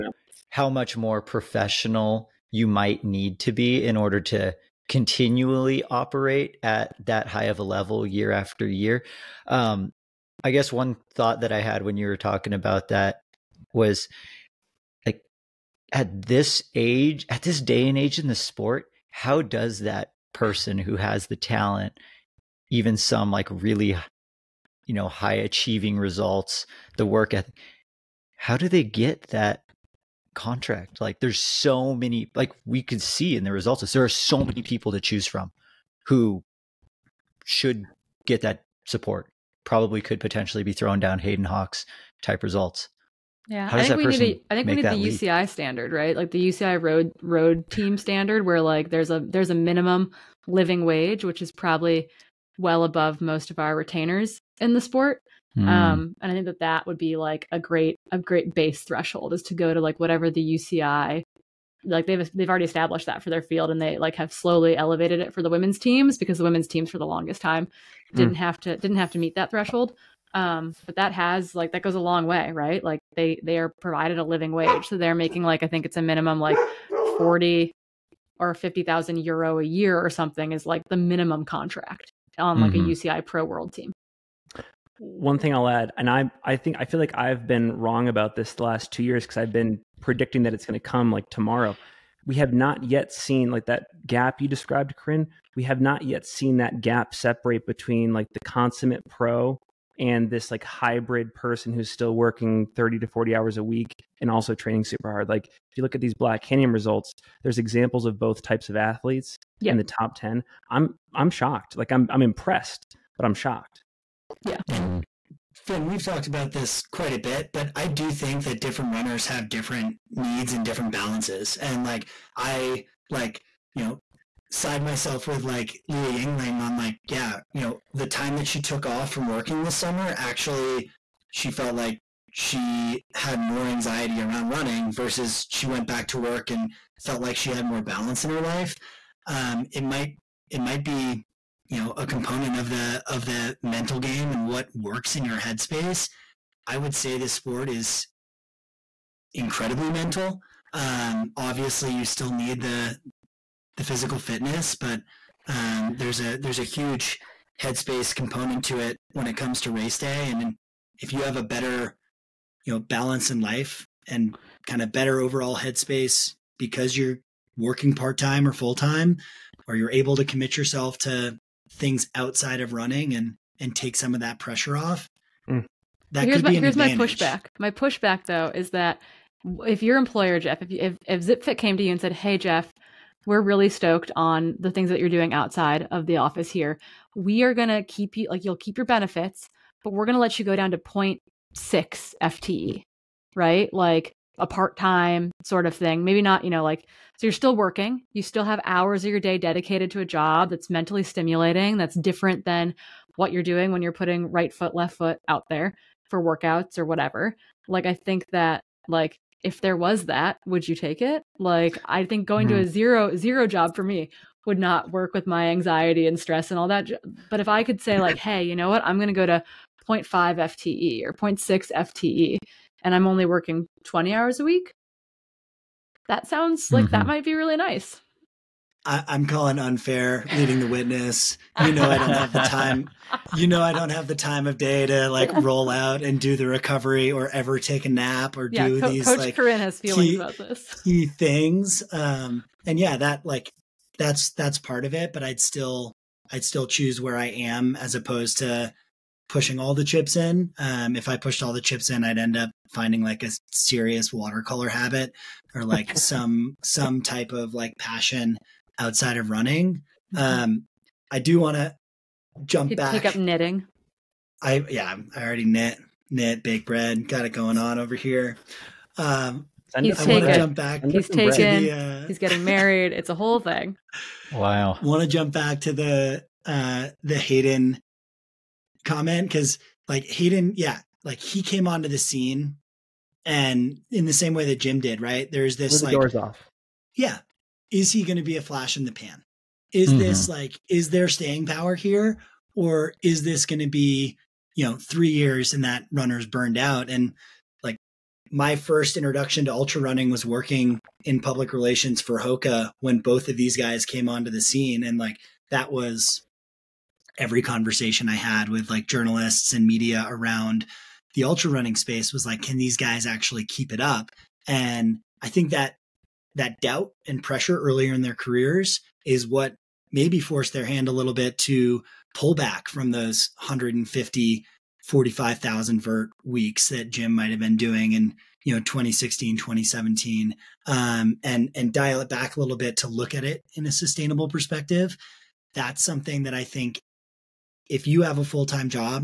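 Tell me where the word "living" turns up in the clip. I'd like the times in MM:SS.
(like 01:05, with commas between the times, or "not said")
00:50, 01:14.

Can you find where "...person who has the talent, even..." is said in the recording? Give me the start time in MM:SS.
00:20.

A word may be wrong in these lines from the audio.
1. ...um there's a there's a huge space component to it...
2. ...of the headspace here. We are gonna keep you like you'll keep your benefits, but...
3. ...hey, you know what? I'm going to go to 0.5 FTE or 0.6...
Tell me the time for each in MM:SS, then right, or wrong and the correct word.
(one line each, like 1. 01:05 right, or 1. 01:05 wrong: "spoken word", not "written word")
1. 02:35 wrong: "headspace", not "space"
2. 03:05 wrong: "office", not "headspace"
3. 03:38 right.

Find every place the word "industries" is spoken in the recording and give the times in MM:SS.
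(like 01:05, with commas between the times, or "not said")
not said.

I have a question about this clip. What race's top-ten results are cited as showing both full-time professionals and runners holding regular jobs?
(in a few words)
Black Canyon.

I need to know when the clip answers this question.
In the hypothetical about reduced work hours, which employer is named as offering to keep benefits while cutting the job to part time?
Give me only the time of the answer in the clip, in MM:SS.
03:01.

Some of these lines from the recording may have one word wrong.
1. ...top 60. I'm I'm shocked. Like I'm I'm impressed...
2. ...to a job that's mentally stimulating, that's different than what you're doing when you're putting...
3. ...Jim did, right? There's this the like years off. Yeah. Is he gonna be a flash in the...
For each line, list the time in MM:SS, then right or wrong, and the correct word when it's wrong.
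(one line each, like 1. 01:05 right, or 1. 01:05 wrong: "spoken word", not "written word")
1. 01:49 wrong: "10", not "60"
2. 03:19 right
3. 04:44 wrong: "doors", not "years".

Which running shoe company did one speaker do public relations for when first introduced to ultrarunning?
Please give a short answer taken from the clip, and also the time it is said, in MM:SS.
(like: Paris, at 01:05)
Hoka, at 05:02.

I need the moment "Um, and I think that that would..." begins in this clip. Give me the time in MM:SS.
00:55.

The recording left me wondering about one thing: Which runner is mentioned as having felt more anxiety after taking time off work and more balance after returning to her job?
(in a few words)
Leah Yingling.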